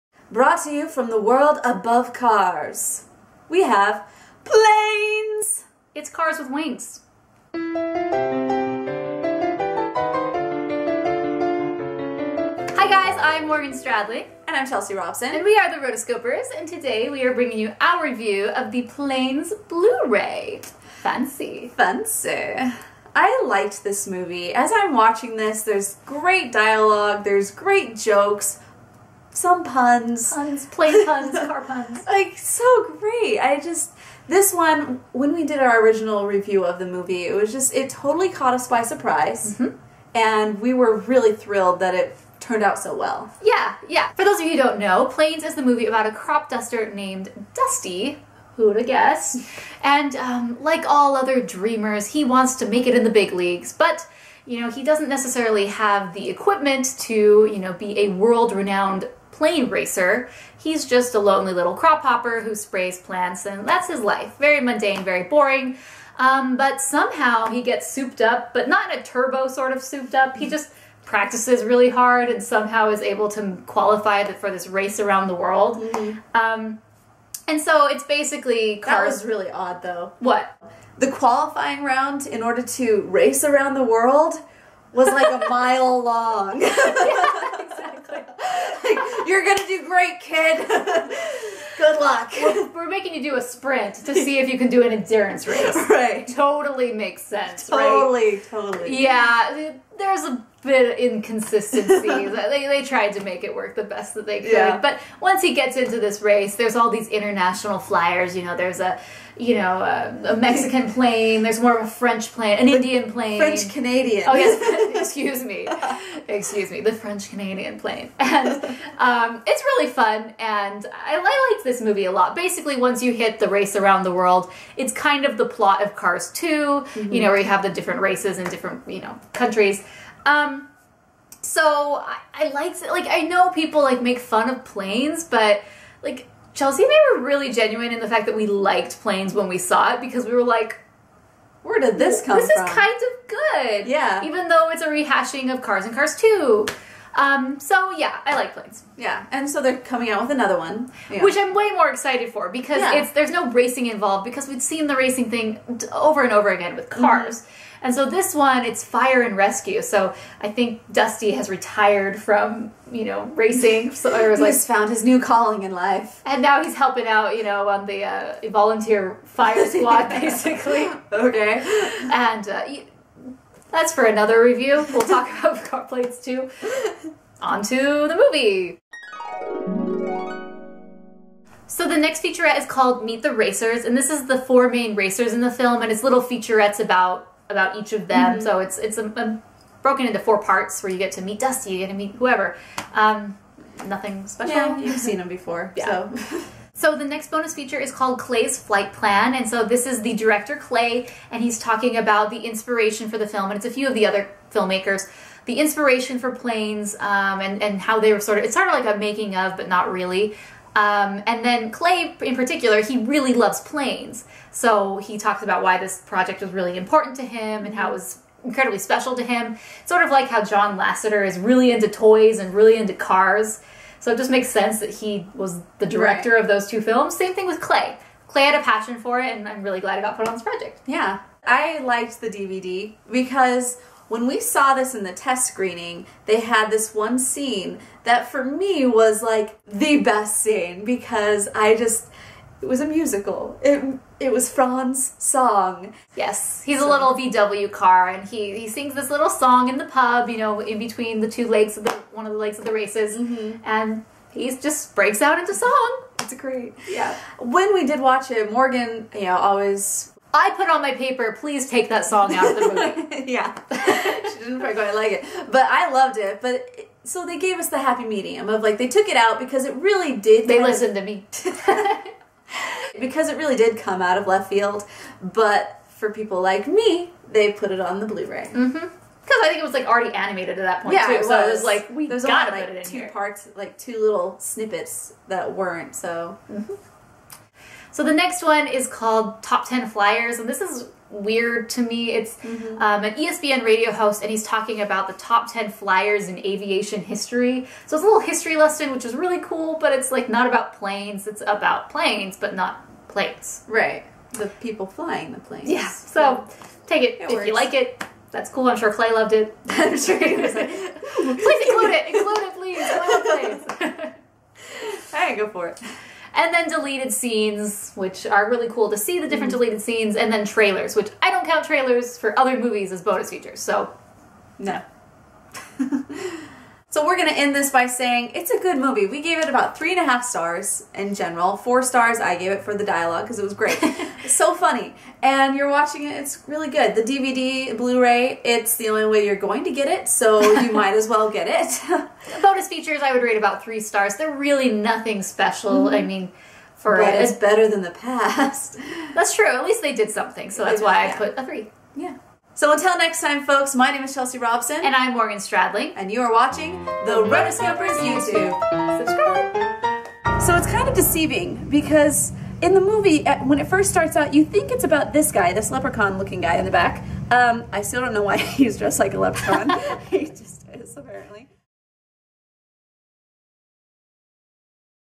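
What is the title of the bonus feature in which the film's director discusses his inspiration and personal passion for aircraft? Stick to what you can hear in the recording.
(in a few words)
Klay's Flight Plan.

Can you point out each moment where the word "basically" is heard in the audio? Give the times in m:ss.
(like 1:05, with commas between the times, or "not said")
1:18, 2:02, 2:50.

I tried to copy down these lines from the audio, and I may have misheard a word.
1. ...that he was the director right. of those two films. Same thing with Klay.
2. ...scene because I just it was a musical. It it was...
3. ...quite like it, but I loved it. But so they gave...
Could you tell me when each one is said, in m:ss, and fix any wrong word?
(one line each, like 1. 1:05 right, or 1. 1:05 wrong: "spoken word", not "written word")
1. 3:44 right
2. 4:00 right
3. 4:24 right.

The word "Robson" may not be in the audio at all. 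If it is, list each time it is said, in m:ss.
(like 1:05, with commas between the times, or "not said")
0:14, 5:54.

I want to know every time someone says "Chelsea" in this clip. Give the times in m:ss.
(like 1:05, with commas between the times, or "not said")
0:14, 2:16, 5:54.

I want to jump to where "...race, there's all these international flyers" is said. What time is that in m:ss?
1:46.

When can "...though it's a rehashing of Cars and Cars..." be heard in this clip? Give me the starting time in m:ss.
2:24.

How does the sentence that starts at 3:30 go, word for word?
Um, and then Klay, in particular, he really loves planes.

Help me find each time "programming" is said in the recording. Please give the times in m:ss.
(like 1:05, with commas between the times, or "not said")
not said.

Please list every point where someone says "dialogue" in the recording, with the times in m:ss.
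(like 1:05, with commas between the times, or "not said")
0:26, 5:32.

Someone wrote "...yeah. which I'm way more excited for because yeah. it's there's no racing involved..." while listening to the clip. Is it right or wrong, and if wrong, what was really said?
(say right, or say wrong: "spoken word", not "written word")
right.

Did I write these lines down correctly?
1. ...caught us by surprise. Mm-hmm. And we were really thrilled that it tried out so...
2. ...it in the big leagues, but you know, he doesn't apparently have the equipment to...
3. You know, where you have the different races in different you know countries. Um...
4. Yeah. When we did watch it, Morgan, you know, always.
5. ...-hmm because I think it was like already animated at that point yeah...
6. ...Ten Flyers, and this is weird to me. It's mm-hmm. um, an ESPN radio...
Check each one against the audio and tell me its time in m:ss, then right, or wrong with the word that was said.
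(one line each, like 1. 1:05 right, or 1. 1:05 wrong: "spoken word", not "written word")
1. 0:38 wrong: "turned", not "tried"
2. 0:52 wrong: "necessarily", not "apparently"
3. 2:07 right
4. 4:16 right
5. 4:38 right
6. 4:49 right.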